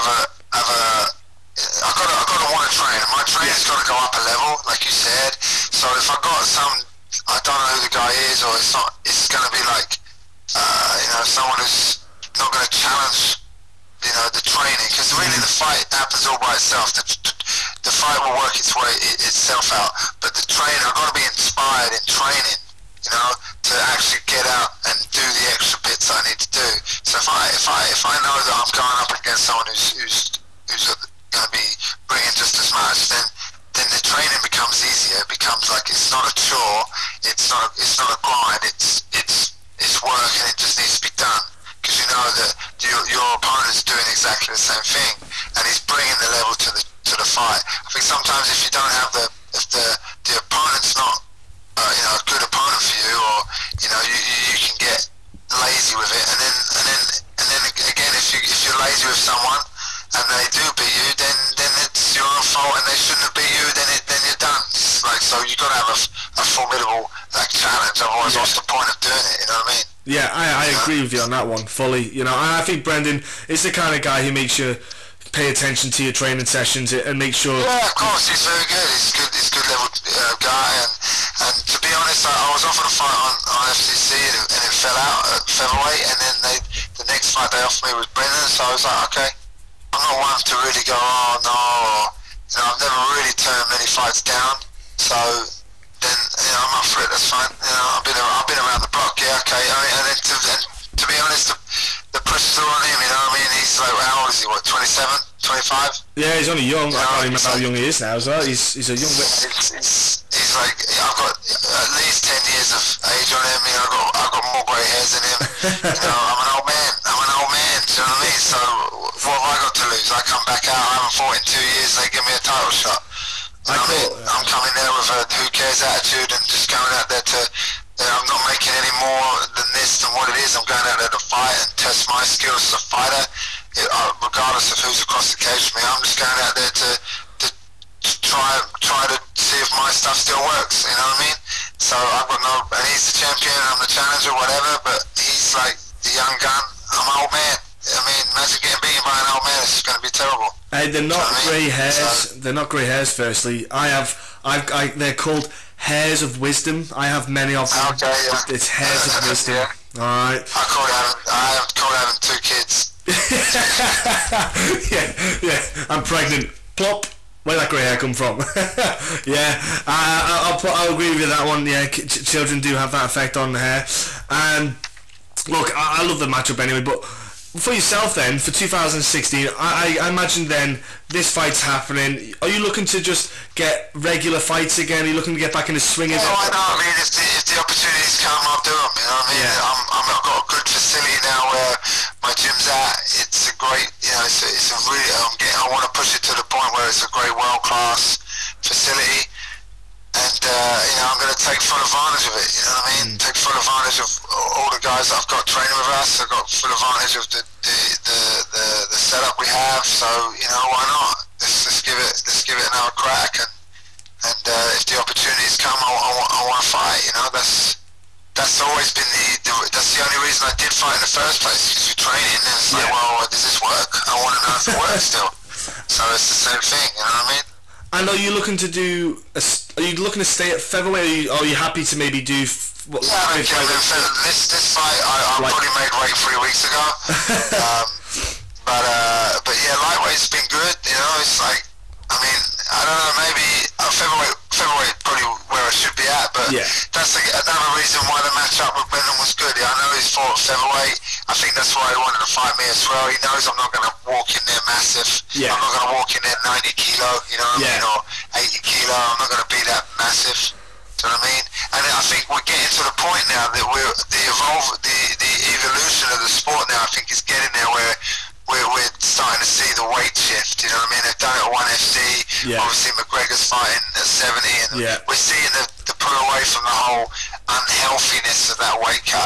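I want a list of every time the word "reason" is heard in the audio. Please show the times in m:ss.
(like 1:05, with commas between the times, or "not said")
3:40, 4:07.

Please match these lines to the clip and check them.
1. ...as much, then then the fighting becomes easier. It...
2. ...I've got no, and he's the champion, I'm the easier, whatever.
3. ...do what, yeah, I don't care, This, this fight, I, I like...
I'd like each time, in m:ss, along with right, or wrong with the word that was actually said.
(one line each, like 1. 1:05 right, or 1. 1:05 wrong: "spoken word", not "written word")
1. 0:32 wrong: "training", not "fighting"
2. 2:21 wrong: "challenger", not "easier"
3. 3:52 right.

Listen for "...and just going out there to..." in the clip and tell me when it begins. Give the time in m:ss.
2:06.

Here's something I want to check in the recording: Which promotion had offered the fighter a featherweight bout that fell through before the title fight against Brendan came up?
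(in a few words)
FCC.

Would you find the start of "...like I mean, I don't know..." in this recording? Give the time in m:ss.
4:01.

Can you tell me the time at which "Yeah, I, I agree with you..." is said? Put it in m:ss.
1:10.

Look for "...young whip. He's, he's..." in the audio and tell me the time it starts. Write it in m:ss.
1:48.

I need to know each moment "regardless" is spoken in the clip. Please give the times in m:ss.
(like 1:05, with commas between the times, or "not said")
2:14.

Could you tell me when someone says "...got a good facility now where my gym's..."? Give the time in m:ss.
3:10.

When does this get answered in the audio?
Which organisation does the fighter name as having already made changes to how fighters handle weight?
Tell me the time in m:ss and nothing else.
4:31.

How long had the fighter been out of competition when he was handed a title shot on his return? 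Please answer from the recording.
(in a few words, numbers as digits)
2 years.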